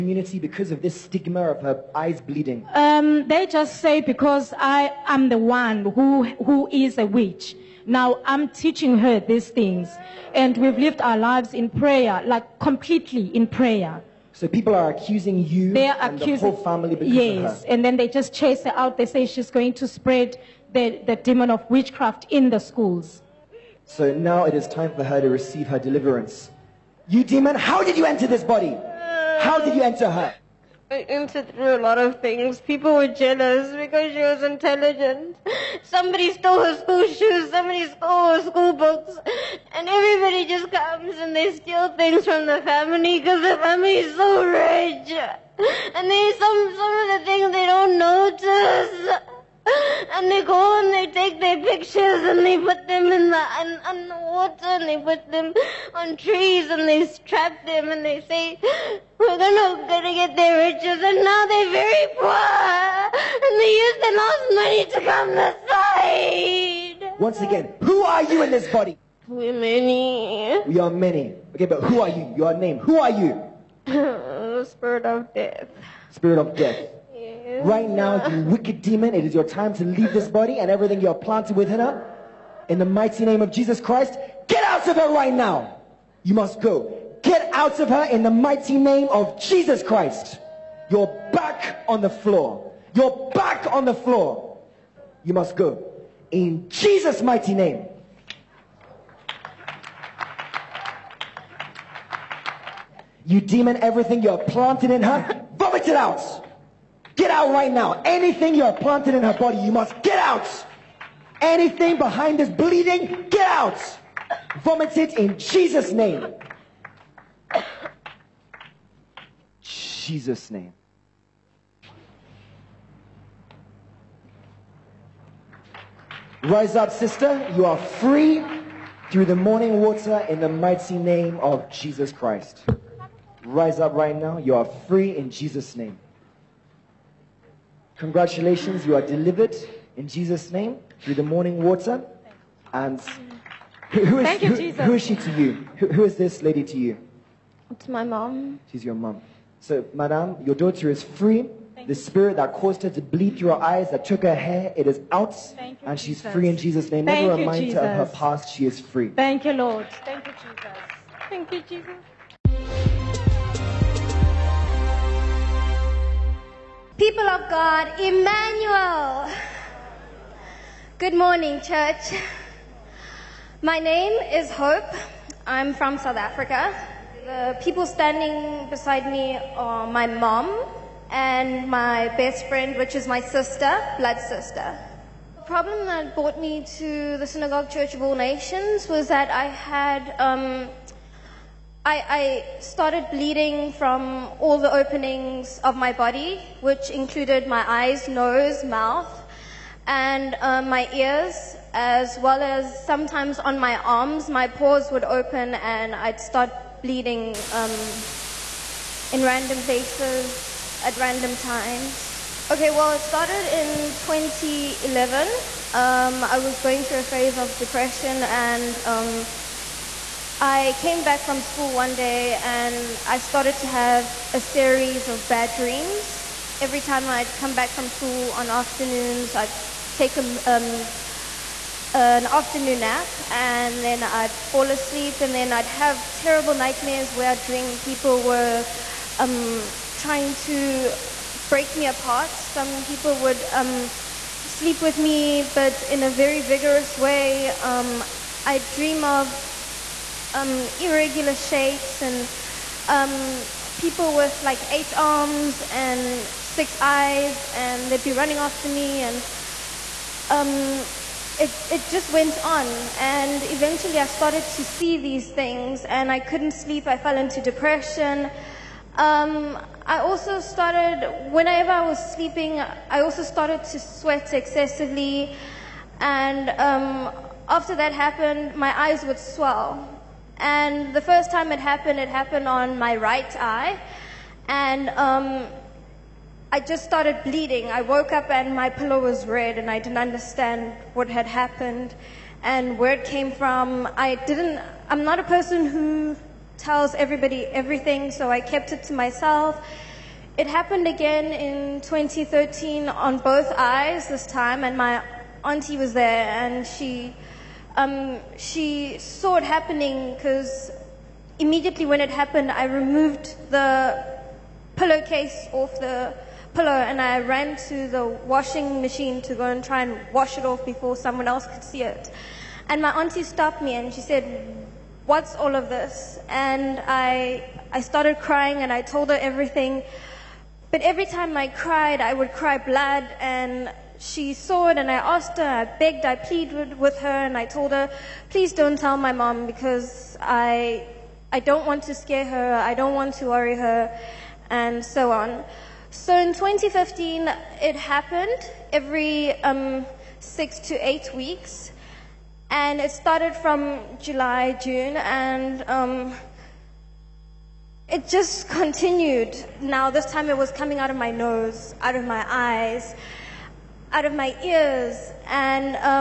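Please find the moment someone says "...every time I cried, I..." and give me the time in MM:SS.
05:30.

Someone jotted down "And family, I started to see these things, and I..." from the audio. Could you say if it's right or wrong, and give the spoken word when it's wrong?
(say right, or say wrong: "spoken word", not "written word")
wrong: "eventually", not "family".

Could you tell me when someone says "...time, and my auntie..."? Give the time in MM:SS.
05:04.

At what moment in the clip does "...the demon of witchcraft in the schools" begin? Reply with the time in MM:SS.
00:21.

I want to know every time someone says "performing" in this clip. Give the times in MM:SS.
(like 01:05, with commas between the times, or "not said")
not said.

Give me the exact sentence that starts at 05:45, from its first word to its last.
So in 2015, it happened every um, six to eight weeks, and it started from July, June, and um, it just continued.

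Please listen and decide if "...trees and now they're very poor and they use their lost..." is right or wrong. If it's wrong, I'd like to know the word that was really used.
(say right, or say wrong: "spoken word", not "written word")
wrong: "riches", not "trees".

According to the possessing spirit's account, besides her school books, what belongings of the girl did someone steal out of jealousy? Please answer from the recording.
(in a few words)
School shoes.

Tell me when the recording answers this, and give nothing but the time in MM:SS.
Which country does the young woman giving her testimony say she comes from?
02:55.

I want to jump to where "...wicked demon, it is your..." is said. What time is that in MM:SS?
01:18.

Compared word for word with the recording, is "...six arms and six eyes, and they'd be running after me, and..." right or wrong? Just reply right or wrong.
wrong.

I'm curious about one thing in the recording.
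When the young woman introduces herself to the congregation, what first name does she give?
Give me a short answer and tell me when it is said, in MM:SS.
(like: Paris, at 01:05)
Hope, at 02:54.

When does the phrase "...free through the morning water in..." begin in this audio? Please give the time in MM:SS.
02:07.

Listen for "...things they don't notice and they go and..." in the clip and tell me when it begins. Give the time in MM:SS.
00:47.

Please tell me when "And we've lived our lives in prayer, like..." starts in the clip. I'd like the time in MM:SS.
00:10.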